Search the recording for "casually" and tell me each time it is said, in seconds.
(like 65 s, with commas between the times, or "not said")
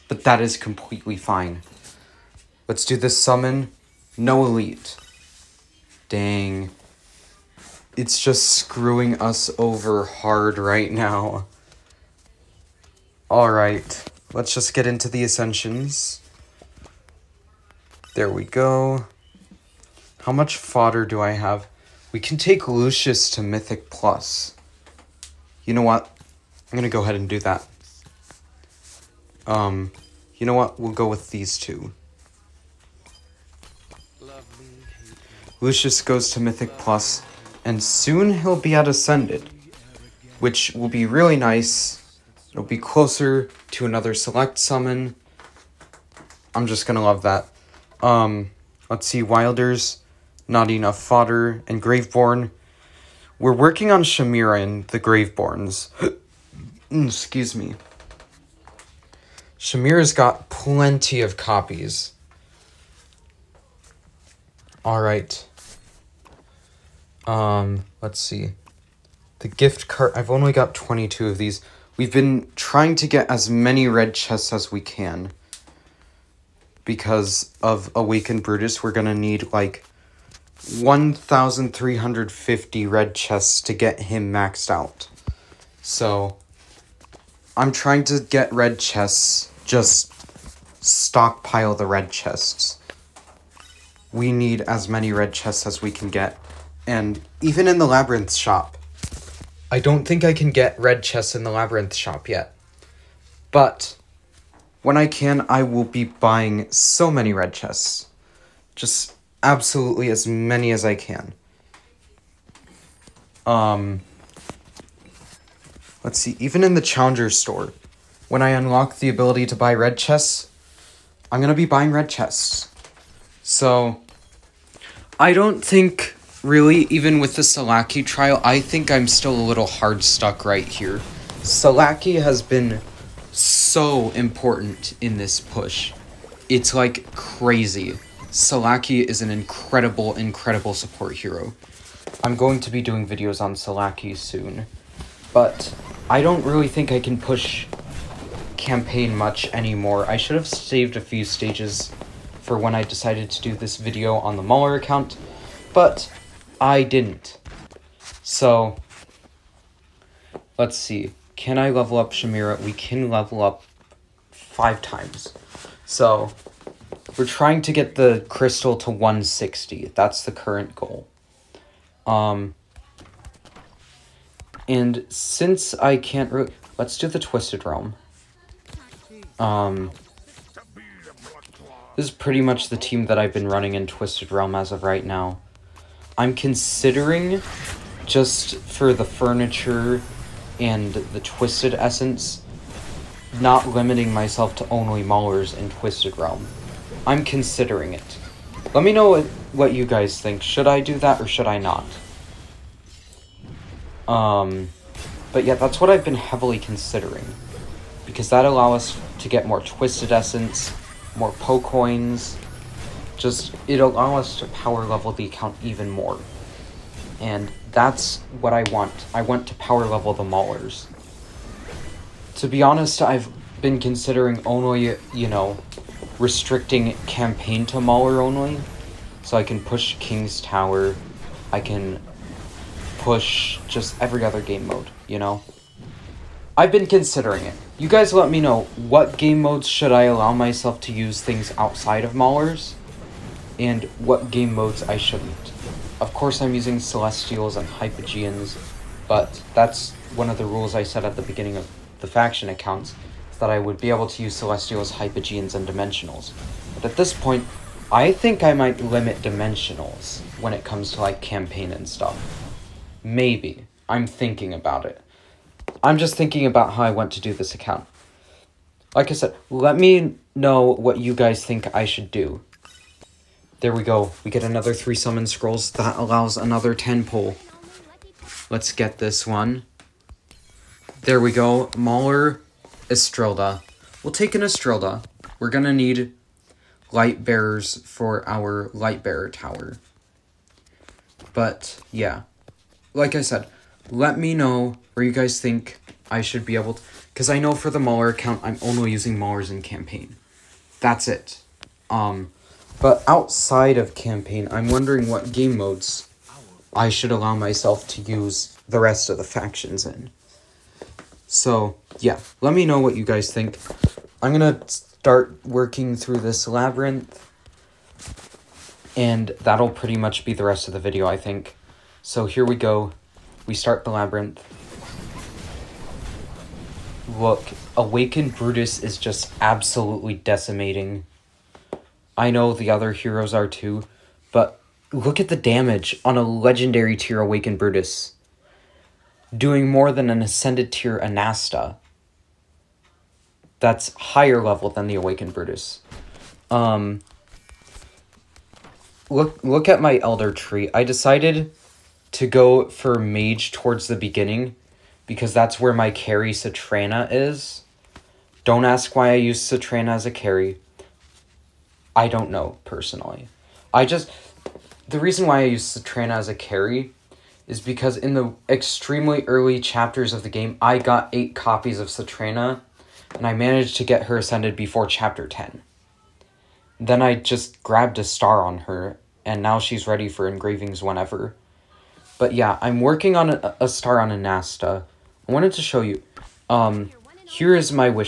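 not said.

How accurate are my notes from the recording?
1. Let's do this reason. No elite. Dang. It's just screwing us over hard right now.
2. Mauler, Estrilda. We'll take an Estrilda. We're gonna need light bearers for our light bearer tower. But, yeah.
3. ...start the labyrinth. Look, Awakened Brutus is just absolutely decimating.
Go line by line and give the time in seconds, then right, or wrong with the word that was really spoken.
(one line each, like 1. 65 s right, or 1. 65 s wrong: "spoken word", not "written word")
1. 2 s wrong: "summon", not "reason"
2. 281 s right
3. 323 s right.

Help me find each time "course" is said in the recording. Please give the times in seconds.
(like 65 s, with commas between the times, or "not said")
246 s.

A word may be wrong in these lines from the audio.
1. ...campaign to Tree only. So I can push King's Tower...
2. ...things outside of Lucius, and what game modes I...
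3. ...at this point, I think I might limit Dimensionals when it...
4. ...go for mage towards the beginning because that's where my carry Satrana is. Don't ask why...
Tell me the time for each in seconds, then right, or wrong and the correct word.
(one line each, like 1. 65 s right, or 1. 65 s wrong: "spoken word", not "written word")
1. 227 s wrong: "Mauler", not "Tree"
2. 241 s wrong: "Maulers", not "Lucius"
3. 256 s right
4. 352 s right.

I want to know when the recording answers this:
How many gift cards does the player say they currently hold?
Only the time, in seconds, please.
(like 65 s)
70 s.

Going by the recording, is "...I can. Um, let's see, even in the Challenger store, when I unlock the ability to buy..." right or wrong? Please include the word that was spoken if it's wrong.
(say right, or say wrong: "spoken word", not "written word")
right.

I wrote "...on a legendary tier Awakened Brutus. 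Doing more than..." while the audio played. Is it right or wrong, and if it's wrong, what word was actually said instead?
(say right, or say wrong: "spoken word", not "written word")
right.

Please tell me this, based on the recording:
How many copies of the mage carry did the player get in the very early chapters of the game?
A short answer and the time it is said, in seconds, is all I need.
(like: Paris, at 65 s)
8, at 371 s.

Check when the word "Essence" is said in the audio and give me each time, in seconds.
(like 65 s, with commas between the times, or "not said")
191 s, 210 s.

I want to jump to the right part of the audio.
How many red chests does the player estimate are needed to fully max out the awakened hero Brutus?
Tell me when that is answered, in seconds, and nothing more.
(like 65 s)
80 s.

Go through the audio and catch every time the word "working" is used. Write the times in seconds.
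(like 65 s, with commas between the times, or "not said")
53 s, 315 s, 382 s.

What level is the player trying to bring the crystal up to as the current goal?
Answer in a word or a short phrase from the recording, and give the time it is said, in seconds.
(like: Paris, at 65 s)
160, at 168 s.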